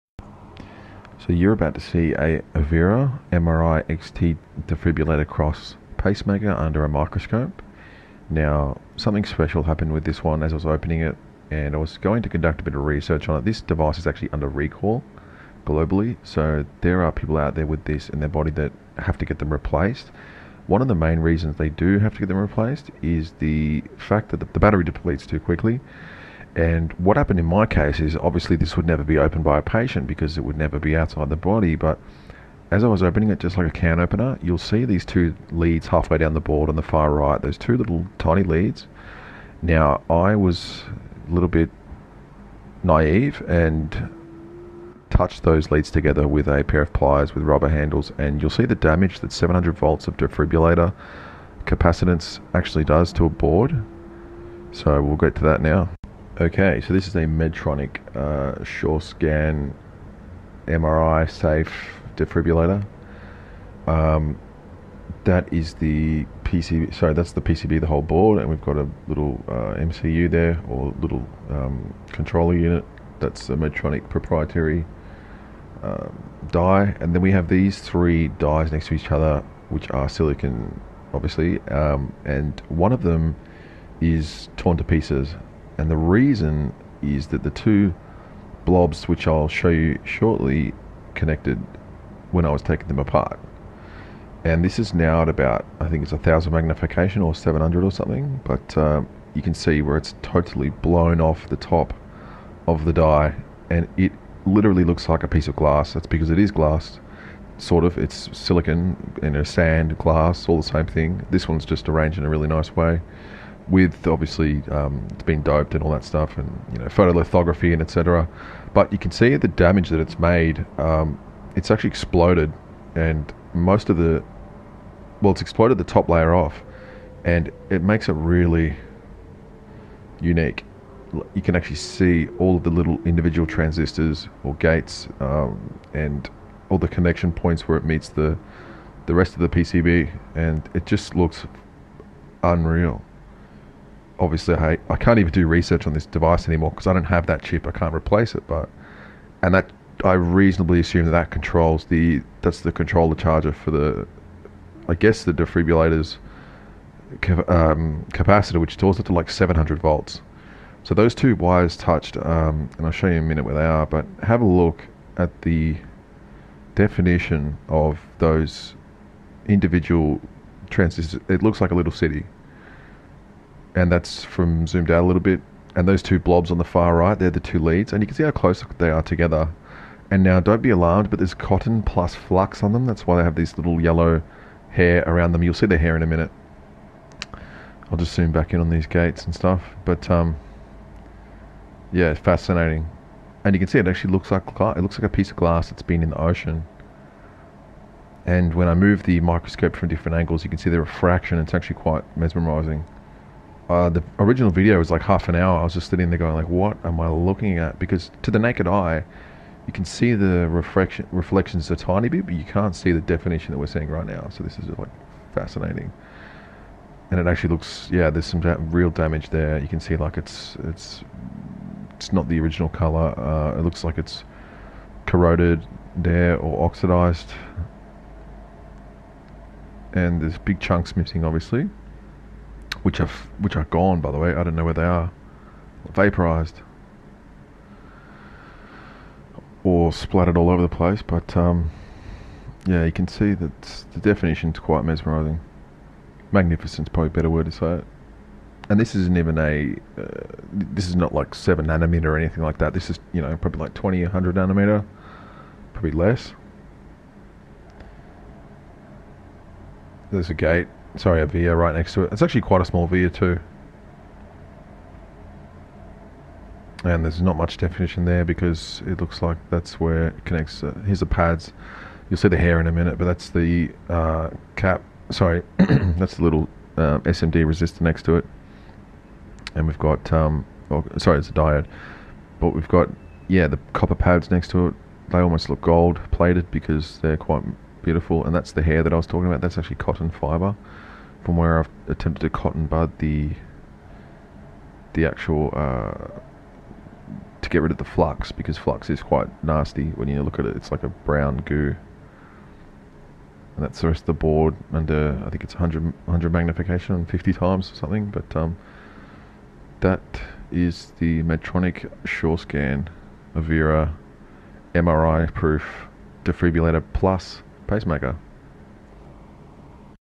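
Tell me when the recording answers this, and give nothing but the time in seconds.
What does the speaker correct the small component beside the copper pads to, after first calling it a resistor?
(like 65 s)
281 s.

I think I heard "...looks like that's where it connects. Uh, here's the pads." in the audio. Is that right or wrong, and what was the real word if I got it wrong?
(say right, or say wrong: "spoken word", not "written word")
right.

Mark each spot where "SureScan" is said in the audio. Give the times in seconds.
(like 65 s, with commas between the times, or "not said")
312 s.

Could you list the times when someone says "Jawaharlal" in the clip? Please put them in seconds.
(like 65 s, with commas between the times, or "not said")
not said.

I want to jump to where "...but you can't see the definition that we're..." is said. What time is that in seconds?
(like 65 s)
212 s.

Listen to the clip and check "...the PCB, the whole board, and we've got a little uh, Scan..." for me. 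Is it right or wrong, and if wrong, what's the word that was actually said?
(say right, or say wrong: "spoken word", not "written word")
wrong: "MCU", not "Scan".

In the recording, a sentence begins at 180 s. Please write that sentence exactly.
And now, don't be alarmed, but there's cotton plus flux on them.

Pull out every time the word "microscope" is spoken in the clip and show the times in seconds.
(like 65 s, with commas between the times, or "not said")
6 s, 199 s.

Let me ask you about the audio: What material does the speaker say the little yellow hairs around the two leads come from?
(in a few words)
Cotton fibre.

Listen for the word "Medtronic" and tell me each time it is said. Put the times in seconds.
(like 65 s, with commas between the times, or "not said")
57 s, 73 s, 311 s.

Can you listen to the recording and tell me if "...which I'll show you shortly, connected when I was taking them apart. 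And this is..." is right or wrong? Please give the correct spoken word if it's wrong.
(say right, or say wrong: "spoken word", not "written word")
right.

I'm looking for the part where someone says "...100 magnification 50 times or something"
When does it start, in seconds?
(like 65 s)
305 s.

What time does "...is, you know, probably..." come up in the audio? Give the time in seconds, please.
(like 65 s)
252 s.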